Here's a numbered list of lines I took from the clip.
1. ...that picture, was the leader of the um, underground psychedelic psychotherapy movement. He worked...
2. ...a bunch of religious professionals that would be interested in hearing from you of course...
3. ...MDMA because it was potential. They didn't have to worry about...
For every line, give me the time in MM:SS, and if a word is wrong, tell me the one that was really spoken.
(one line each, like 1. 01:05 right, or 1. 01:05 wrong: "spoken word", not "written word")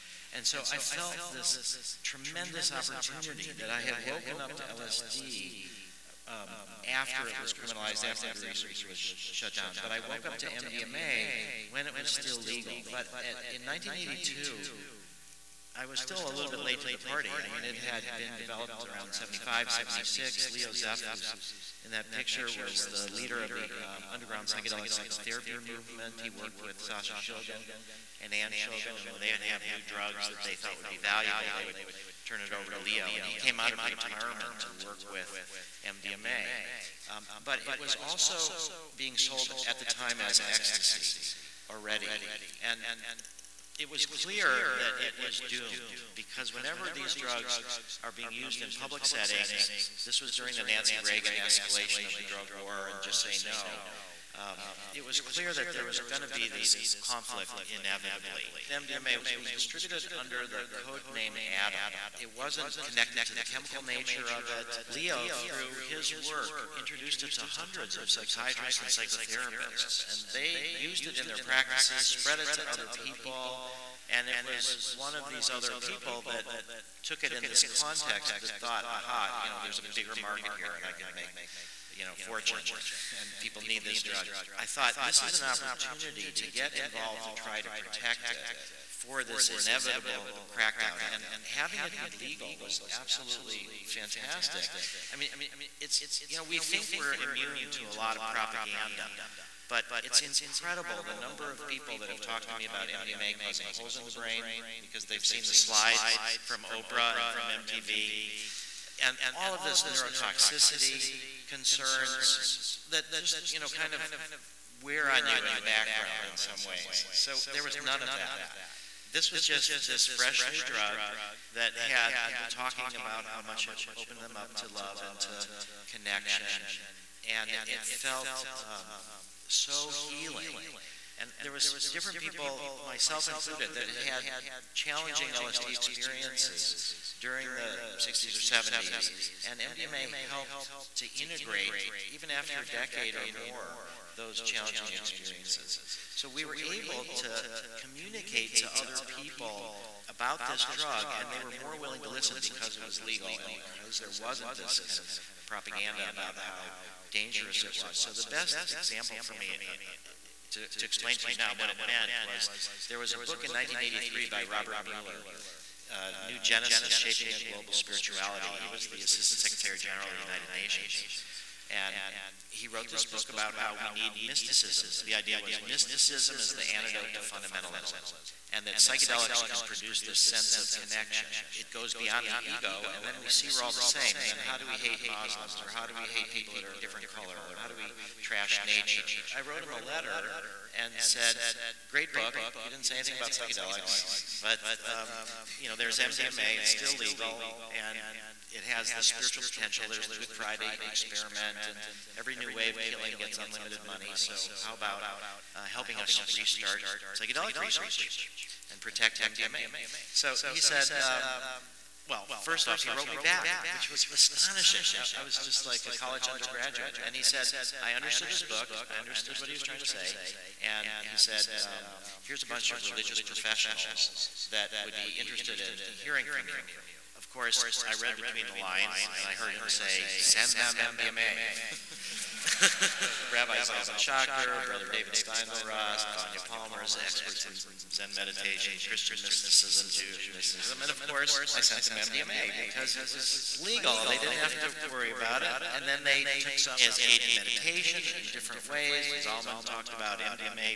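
1. 00:21 right
2. 03:42 right
3. 04:01 wrong: "legal", not "potential".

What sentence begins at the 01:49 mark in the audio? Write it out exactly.
And all of this neurotoxicity concerns that just, you know, kind of wear on you in the background in some ways.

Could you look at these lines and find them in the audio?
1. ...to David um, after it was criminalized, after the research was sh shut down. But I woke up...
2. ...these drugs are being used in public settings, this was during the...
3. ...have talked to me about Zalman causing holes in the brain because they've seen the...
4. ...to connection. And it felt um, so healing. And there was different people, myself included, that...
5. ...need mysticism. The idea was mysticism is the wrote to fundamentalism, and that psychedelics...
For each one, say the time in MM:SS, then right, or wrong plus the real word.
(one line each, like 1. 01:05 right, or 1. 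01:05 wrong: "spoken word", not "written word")
1. 00:04 wrong: "LSD", not "David"
2. 00:46 right
3. 01:42 wrong: "MDMA", not "Zalman"
4. 02:05 right
5. 02:53 wrong: "antidote", not "wrote".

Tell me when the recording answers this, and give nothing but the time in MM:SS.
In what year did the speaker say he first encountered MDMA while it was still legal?
00:13.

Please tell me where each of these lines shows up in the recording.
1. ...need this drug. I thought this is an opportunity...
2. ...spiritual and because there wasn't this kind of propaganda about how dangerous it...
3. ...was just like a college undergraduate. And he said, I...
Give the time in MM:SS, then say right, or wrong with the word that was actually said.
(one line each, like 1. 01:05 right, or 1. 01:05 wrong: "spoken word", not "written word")
1. 01:23 right
2. 02:33 wrong: "legal", not "spiritual"
3. 03:35 right.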